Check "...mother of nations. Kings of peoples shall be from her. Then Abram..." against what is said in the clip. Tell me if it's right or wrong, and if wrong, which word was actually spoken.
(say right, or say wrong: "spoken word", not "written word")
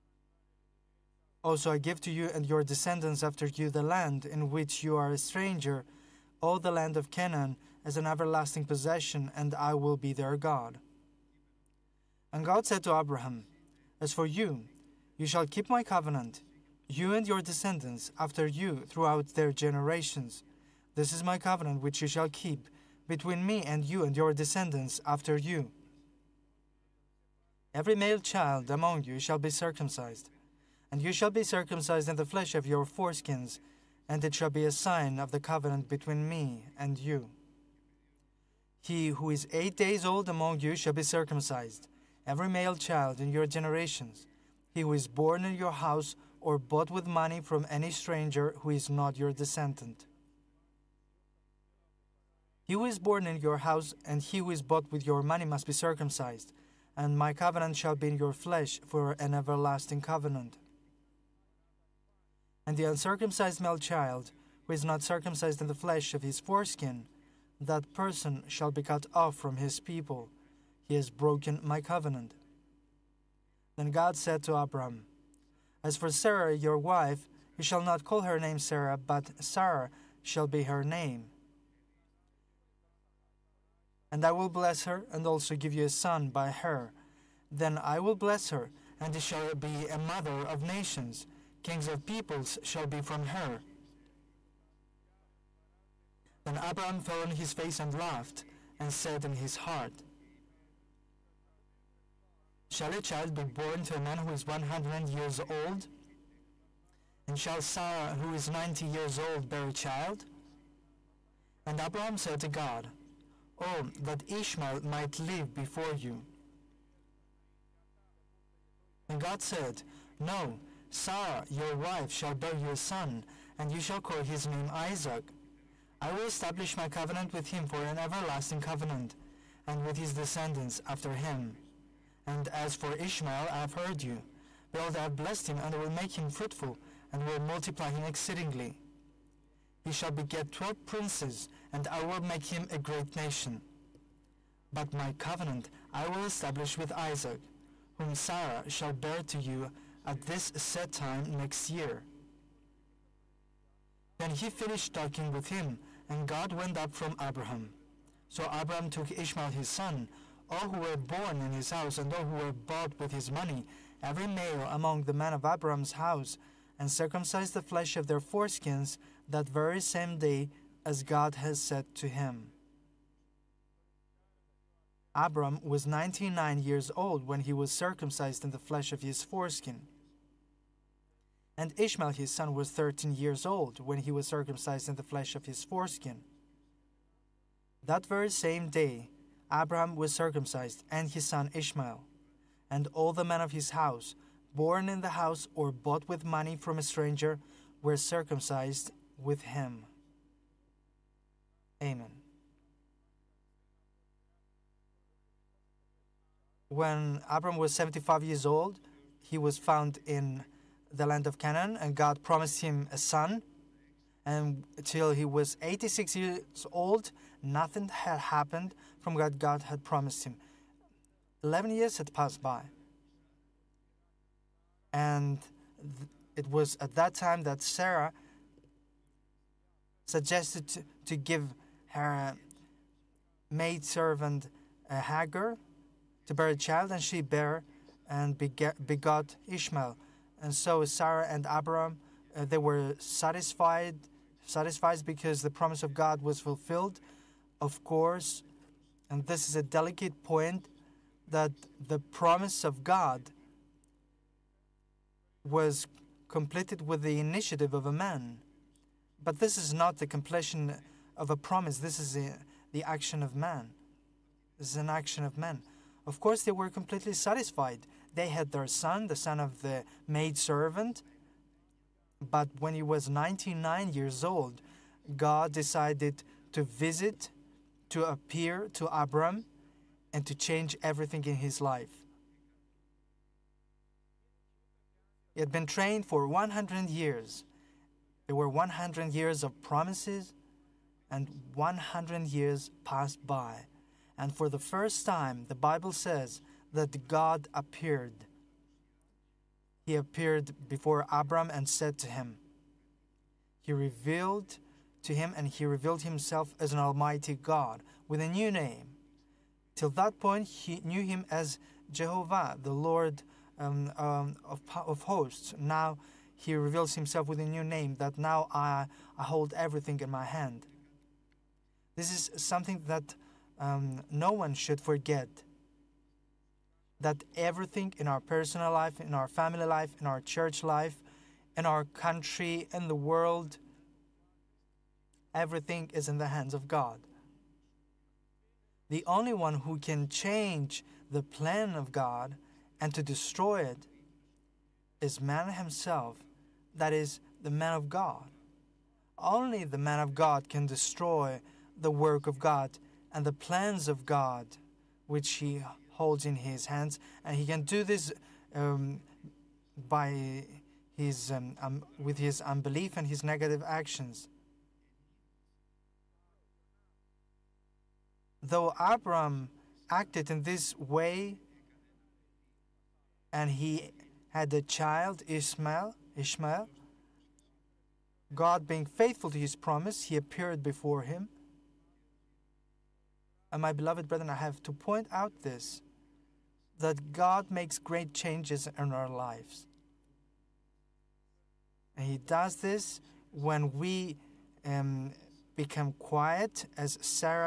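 right.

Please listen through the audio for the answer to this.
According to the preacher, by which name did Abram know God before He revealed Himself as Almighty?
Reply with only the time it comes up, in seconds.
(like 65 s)
311 s.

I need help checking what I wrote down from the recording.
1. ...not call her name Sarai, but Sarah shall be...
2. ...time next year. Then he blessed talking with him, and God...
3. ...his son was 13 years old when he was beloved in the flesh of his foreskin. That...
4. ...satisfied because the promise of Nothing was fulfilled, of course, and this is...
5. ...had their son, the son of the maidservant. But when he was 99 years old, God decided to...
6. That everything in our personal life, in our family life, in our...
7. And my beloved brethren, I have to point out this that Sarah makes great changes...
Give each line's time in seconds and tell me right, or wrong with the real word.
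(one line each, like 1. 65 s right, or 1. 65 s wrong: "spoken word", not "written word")
1. 77 s right
2. 150 s wrong: "finished", not "blessed"
3. 182 s wrong: "circumcised", not "beloved"
4. 244 s wrong: "God", not "Nothing"
5. 268 s right
6. 326 s right
7. 383 s wrong: "God", not "Sarah".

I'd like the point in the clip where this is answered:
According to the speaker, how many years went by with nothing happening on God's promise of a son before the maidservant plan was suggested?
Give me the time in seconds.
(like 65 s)
221 s.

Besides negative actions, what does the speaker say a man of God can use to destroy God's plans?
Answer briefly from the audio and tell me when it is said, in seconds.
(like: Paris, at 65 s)
Unbelief, at 362 s.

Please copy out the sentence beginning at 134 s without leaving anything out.
Behold, I have blessed him, and will make him fruitful, and will multiply him exceedingly.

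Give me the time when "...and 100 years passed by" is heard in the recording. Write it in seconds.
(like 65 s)
291 s.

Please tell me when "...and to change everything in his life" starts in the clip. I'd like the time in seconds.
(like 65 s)
280 s.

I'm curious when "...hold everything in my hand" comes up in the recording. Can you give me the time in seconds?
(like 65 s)
319 s.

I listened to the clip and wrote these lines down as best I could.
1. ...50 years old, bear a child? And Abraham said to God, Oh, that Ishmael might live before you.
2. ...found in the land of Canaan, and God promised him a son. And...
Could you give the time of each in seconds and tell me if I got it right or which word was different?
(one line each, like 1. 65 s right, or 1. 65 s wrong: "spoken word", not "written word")
1. 108 s wrong: "90", not "50"
2. 209 s right.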